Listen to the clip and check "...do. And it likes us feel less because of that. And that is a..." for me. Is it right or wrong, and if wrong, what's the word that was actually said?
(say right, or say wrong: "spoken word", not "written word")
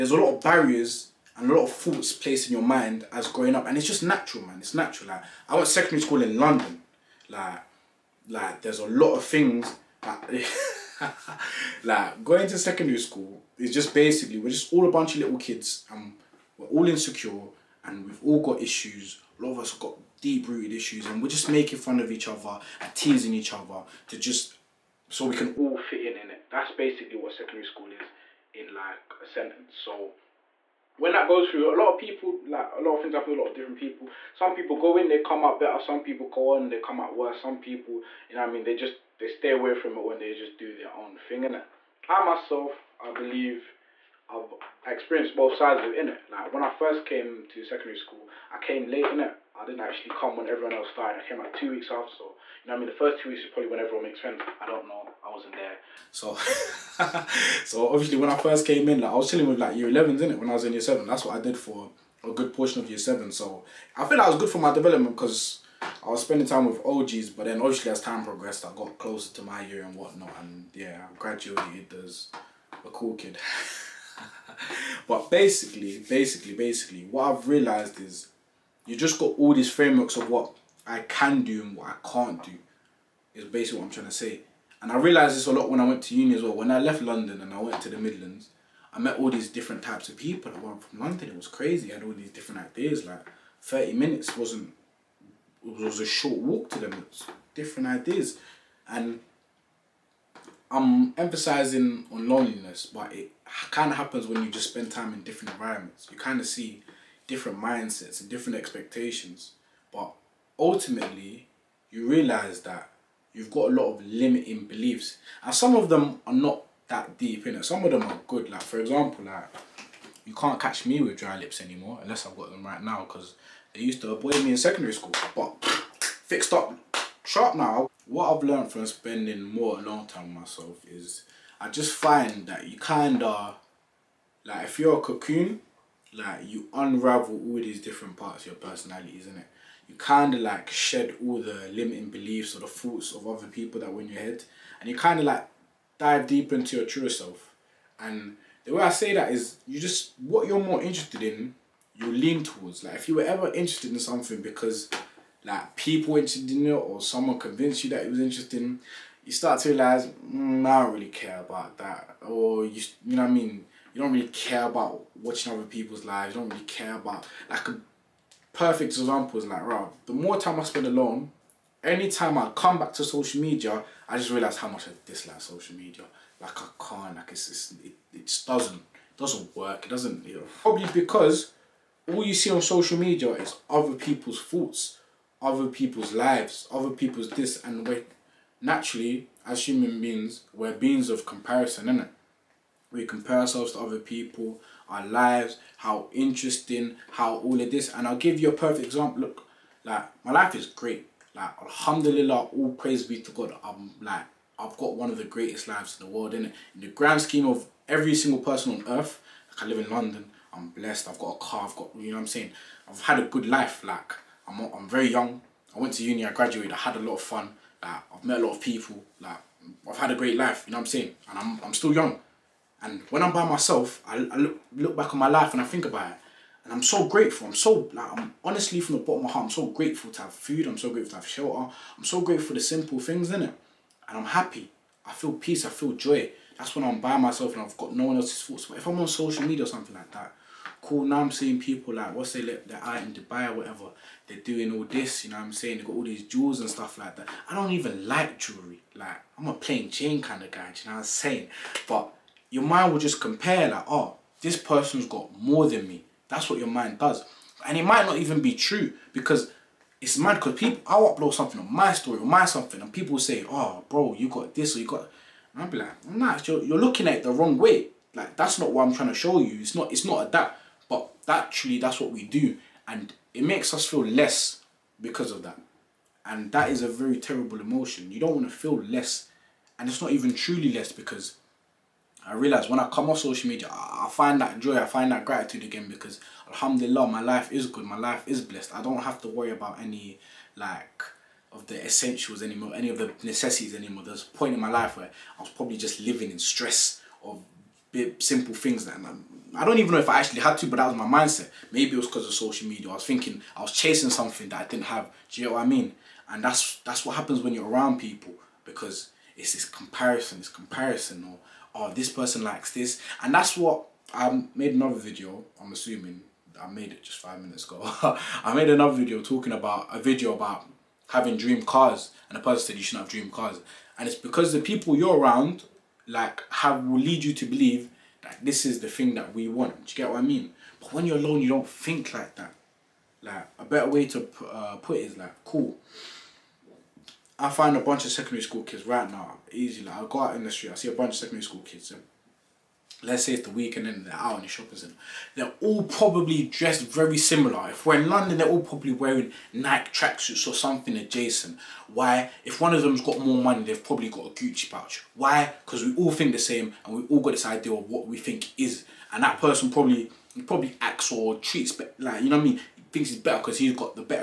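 wrong: "makes", not "likes".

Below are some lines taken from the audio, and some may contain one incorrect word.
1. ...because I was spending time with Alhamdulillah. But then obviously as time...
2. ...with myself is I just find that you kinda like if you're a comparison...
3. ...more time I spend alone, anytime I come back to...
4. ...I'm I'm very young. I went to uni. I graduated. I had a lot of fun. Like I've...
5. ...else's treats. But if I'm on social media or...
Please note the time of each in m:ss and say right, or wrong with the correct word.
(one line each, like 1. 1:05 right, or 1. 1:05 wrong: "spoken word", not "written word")
1. 1:05 wrong: "OGs", not "Alhamdulillah"
2. 2:10 wrong: "cocoon", not "comparison"
3. 2:50 right
4. 3:34 right
5. 3:58 wrong: "thoughts", not "treats".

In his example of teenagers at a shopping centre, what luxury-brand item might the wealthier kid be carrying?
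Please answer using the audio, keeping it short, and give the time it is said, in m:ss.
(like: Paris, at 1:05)
A Gucci pouch, at 5:54.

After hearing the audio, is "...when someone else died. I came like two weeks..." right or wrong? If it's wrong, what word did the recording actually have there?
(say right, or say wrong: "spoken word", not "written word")
wrong: "everyone", not "someone".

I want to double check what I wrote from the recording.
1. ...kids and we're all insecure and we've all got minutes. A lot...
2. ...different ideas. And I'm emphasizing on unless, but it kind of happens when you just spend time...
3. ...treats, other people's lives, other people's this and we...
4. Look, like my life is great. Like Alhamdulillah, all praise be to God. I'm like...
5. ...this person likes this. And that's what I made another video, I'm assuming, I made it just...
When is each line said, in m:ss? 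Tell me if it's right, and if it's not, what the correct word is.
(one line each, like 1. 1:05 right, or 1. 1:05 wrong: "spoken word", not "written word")
1. 0:15 wrong: "issues", not "minutes"
2. 1:37 wrong: "loneliness", not "unless"
3. 3:04 wrong: "thoughts", not "treats"
4. 3:19 right
5. 5:11 right.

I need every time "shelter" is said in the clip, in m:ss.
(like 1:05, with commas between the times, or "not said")
3:51.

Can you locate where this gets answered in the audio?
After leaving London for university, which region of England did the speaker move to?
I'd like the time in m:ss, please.
1:27.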